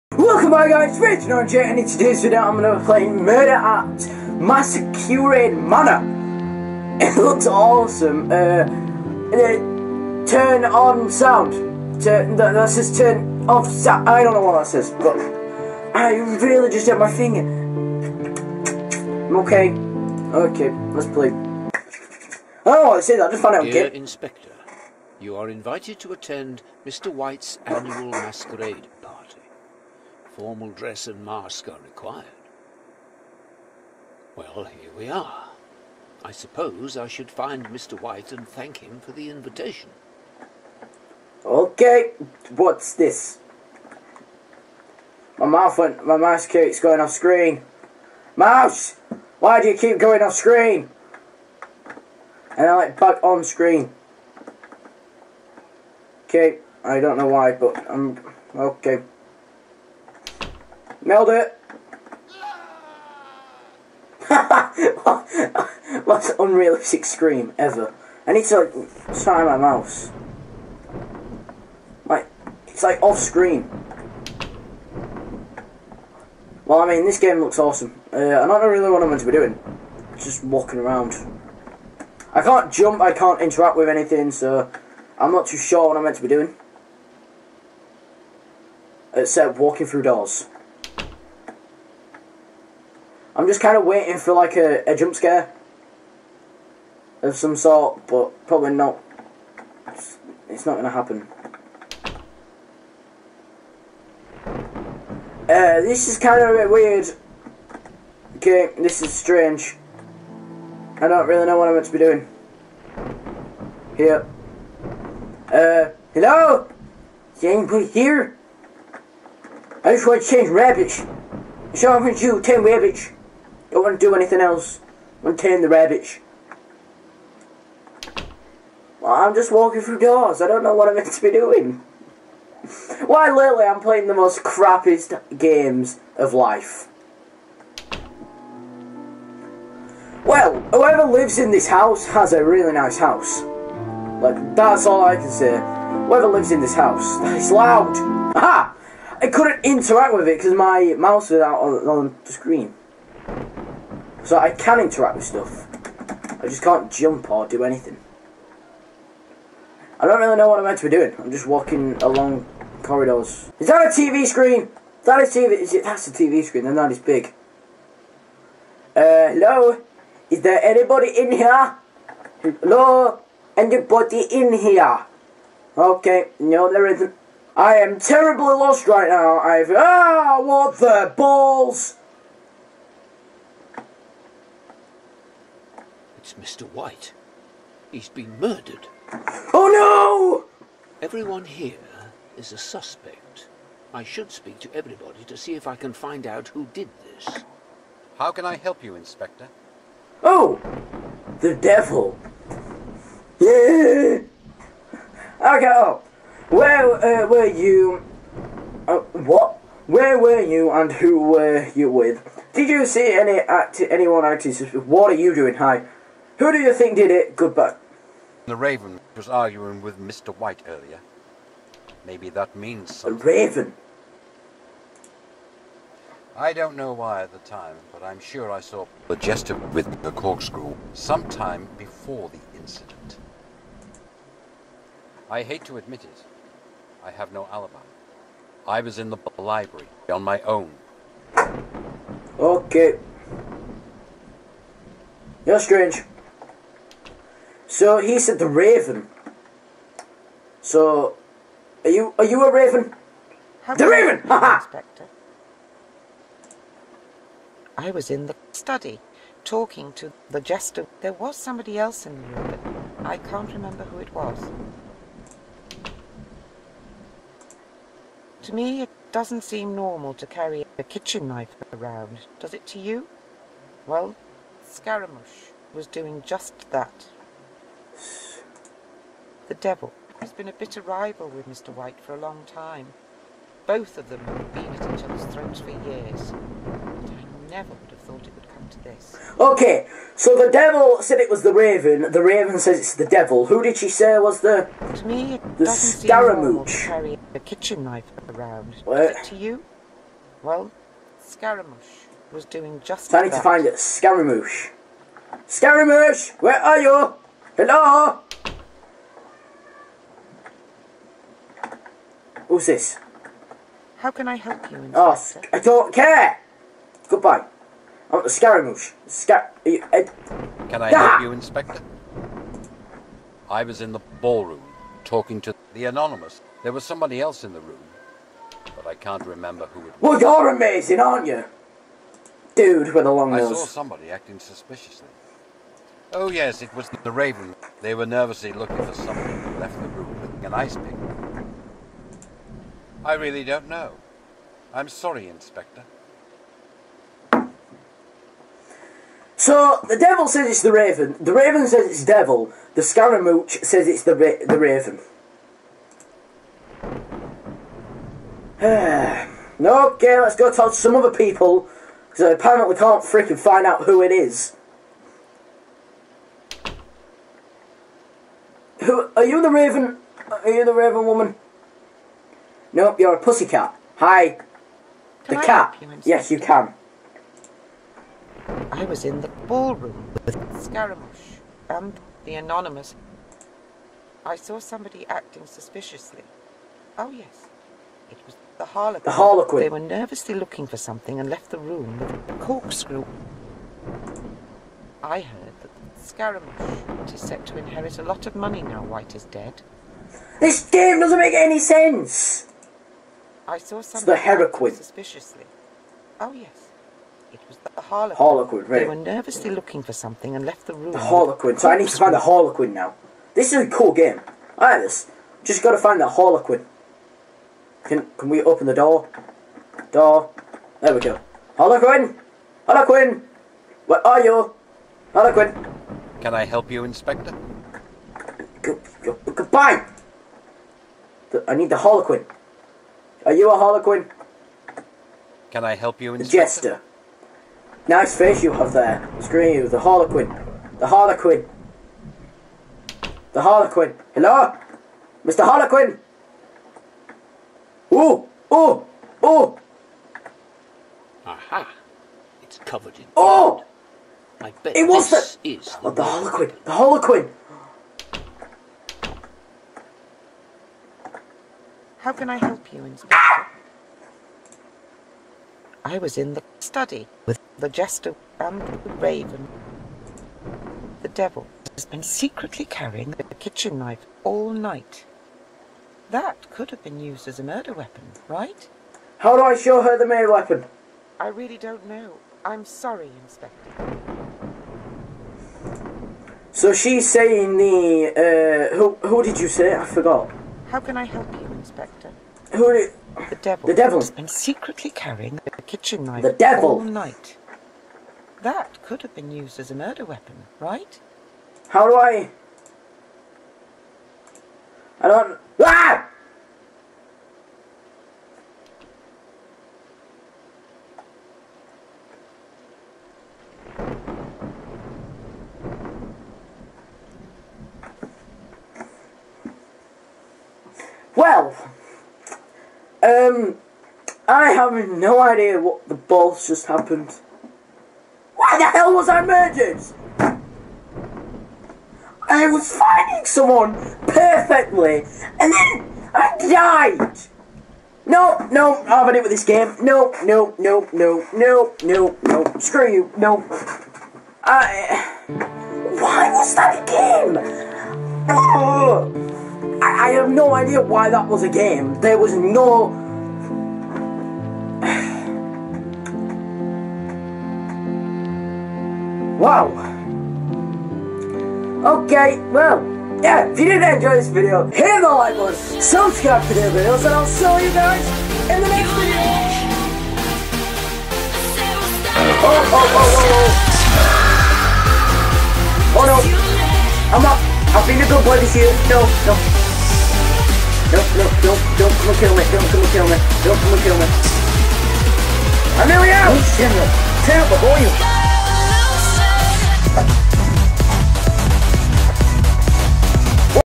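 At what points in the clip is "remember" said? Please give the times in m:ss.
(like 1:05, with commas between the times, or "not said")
4:23, 5:29.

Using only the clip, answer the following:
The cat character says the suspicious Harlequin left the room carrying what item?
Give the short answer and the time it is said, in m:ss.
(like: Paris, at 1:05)
a corkscrew, at 6:31.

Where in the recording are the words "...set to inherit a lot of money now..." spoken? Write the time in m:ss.
6:37.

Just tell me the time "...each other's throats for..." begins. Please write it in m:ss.
4:44.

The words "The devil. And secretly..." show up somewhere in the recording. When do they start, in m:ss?
8:13.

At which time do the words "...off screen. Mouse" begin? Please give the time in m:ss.
0:47.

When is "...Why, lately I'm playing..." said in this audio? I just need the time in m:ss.
2:13.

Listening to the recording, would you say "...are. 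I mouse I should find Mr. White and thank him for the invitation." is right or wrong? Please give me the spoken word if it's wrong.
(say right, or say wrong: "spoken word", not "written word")
wrong: "suppose", not "mouse".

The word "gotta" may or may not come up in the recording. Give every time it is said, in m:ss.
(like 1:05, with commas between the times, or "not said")
6:55.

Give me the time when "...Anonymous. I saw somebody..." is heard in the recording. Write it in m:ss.
6:22.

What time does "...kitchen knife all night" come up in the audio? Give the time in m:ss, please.
7:53.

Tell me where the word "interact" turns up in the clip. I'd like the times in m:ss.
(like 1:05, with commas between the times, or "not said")
1:23, 2:29, 2:34.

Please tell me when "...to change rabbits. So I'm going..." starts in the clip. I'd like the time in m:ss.
2:00.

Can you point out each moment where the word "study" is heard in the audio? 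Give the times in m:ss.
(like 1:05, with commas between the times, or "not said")
4:18, 7:46.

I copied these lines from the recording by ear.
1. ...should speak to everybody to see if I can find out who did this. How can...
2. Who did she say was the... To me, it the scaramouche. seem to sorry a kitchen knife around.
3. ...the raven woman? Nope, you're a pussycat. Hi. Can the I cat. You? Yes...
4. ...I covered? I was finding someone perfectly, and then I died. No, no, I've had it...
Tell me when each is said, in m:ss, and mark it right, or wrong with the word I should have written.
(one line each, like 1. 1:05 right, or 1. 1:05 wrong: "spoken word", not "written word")
1. 3:14 right
2. 4:53 wrong: "carry", not "sorry"
3. 6:10 right
4. 8:49 wrong: "murdered", not "covered".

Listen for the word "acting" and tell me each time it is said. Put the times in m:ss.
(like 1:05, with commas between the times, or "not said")
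3:34, 5:34, 6:25.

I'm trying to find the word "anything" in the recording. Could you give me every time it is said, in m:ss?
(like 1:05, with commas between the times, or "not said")
1:23, 2:04, 2:37.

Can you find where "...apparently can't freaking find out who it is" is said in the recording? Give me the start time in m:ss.
6:02.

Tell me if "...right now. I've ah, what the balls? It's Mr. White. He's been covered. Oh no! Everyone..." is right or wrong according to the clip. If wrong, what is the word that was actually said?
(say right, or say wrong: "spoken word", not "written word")
wrong: "murdered", not "covered".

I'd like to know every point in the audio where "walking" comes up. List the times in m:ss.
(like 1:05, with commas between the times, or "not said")
1:20, 1:29, 2:09, 2:41.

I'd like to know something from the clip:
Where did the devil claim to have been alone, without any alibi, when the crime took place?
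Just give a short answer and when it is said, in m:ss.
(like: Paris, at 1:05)
the library, at 3:58.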